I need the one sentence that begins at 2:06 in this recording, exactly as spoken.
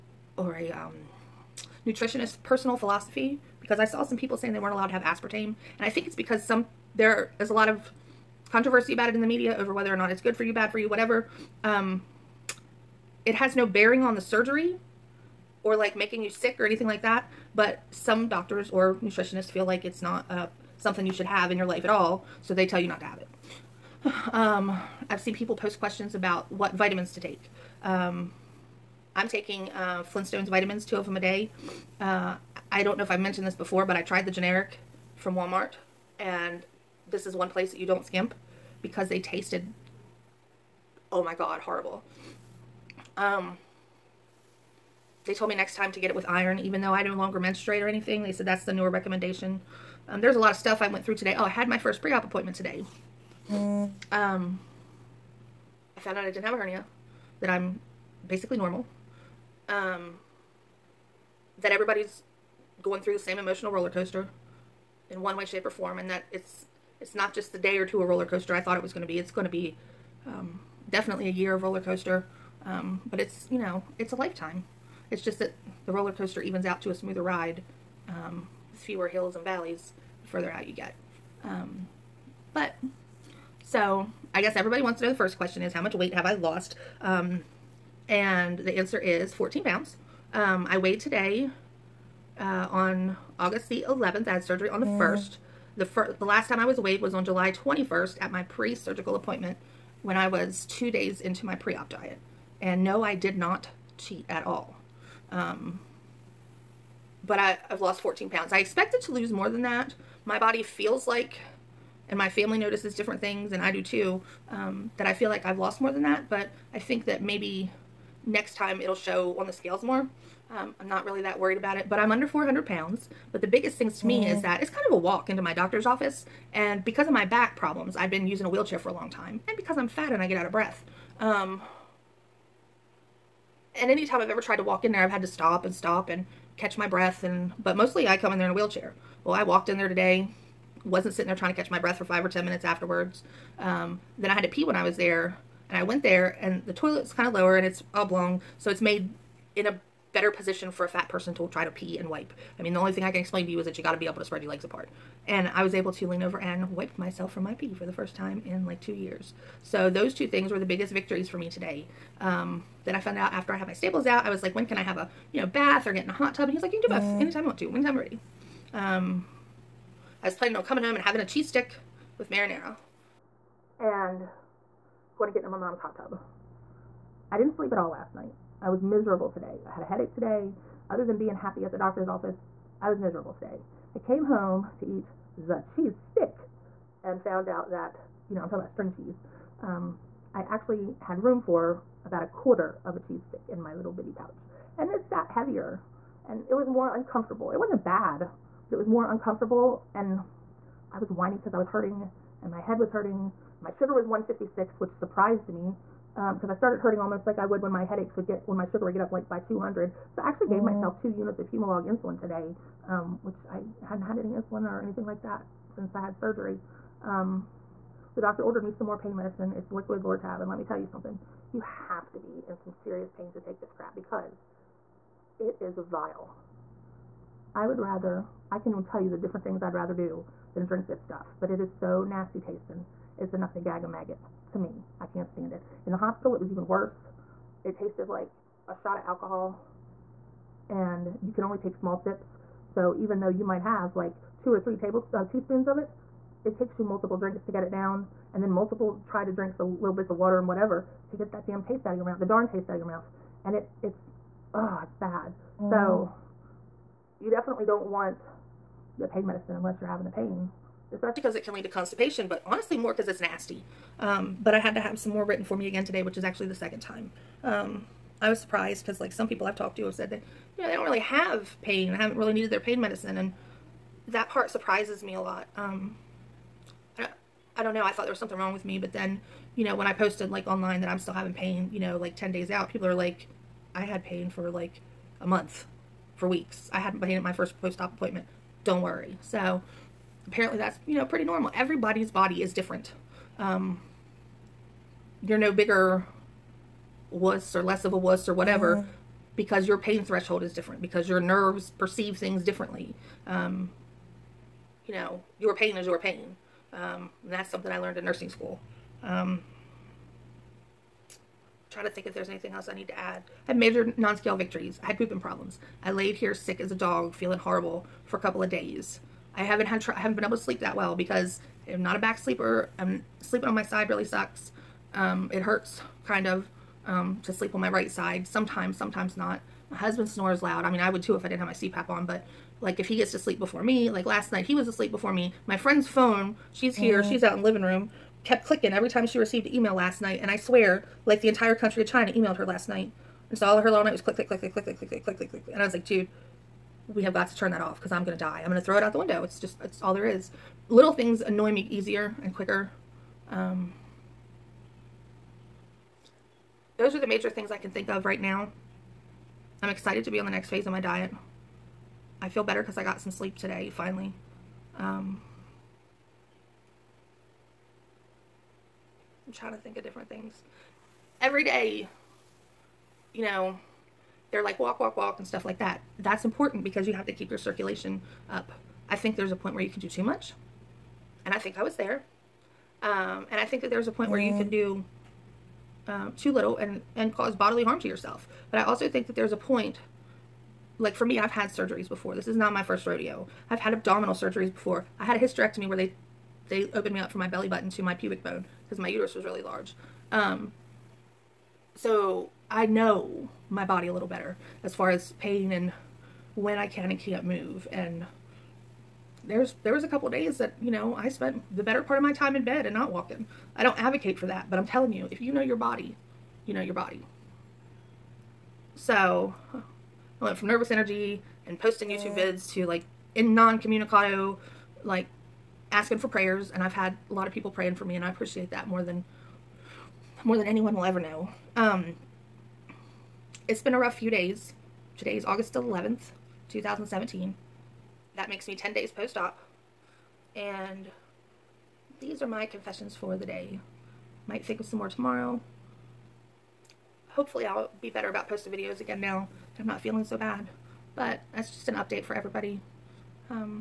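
And because of my back problems, I'd been using a wheelchair for a long time.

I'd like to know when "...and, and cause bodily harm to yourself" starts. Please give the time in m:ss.
6:26.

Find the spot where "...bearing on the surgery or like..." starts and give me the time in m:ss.
0:13.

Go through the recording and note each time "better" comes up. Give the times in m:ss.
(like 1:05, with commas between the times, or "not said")
2:30, 6:02, 6:44, 6:51, 7:27.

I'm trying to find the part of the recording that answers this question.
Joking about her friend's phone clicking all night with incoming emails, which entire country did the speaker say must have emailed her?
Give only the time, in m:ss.
5:41.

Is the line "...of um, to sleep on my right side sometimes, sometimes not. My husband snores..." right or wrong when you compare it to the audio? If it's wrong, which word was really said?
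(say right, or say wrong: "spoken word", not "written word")
right.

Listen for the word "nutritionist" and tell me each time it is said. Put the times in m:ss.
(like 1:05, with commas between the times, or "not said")
0:01, 0:19.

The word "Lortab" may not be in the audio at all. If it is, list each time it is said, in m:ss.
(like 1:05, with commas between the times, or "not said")
3:40.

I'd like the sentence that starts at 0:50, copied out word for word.
Um, there's a lot of stuff I went through today.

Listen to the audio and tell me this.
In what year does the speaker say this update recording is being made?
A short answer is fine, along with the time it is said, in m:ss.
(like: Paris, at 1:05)
2017, at 7:16.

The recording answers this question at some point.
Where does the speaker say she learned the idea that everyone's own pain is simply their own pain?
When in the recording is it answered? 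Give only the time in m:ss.
5:08.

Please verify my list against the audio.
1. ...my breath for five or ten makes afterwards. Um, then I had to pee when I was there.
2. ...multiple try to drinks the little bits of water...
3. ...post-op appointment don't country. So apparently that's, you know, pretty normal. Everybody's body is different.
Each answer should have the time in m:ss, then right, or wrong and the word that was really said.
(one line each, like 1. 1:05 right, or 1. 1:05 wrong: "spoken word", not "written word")
1. 2:21 wrong: "minutes", not "makes"
2. 4:08 right
3. 4:47 wrong: "worry", not "country".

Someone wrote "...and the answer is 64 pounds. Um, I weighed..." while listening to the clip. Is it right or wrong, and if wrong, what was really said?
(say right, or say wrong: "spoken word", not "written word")
wrong: "14", not "64".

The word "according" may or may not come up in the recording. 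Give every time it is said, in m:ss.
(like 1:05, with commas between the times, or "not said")
not said.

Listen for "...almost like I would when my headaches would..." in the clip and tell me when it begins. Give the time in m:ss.
3:26.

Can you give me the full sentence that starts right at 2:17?
And But mostly I come in there in a wheelchair.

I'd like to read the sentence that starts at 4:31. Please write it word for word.
I haven't really needed their pain medicine.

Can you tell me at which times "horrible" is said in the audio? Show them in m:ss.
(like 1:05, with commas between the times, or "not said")
0:41, 5:17.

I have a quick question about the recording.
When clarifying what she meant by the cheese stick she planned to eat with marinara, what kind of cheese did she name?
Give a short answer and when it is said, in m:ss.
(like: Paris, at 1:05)
String cheese, at 3:08.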